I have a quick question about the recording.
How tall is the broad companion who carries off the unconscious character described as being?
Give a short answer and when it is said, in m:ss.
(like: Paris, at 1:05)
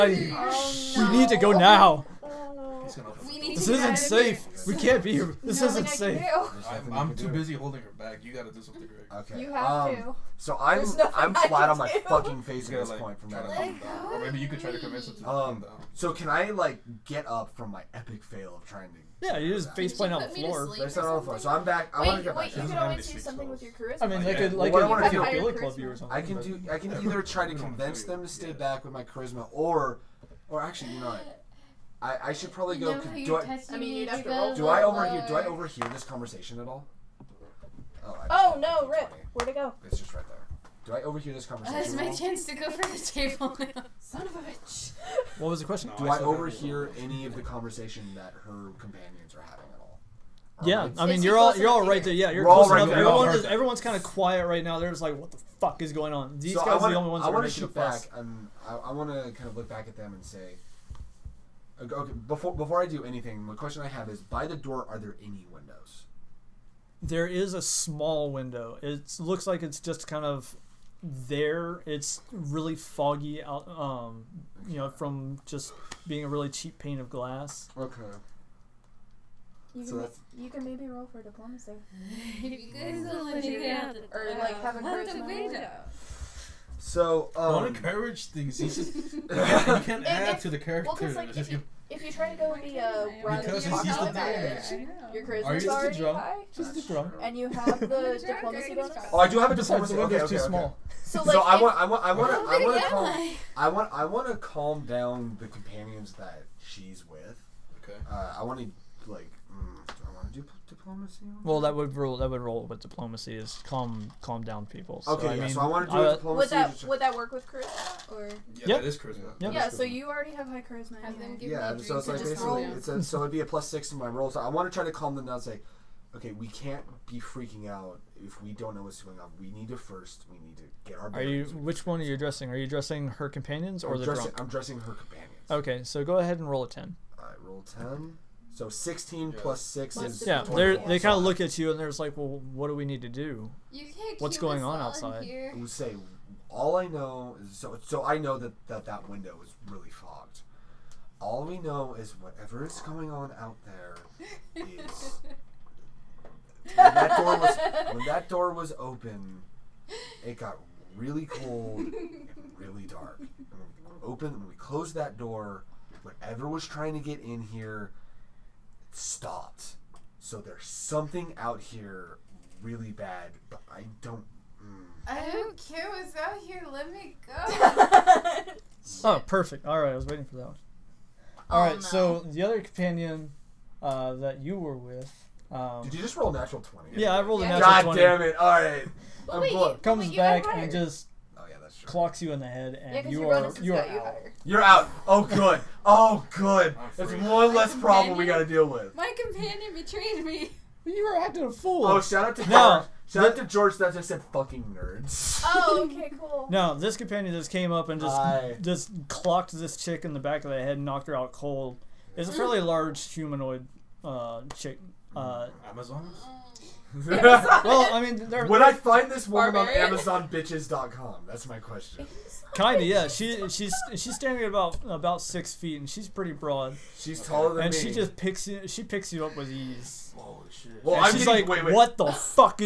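6 feet, at 3:45.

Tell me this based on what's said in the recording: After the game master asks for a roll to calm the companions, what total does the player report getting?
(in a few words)
16.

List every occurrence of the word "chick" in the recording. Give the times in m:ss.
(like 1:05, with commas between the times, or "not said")
3:29, 3:34.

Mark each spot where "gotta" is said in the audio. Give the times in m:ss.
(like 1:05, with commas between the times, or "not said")
0:08.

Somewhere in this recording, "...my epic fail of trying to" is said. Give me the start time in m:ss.
0:17.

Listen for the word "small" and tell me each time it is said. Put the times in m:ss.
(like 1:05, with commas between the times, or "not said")
1:07, 1:40.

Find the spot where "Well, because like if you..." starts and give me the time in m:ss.
1:30.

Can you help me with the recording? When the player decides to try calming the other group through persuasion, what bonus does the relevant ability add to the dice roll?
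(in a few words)
+6.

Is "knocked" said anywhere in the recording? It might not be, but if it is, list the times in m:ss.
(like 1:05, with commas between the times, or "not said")
3:30.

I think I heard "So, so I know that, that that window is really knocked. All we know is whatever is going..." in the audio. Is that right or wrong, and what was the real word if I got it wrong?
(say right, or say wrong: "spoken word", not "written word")
wrong: "fogged", not "knocked".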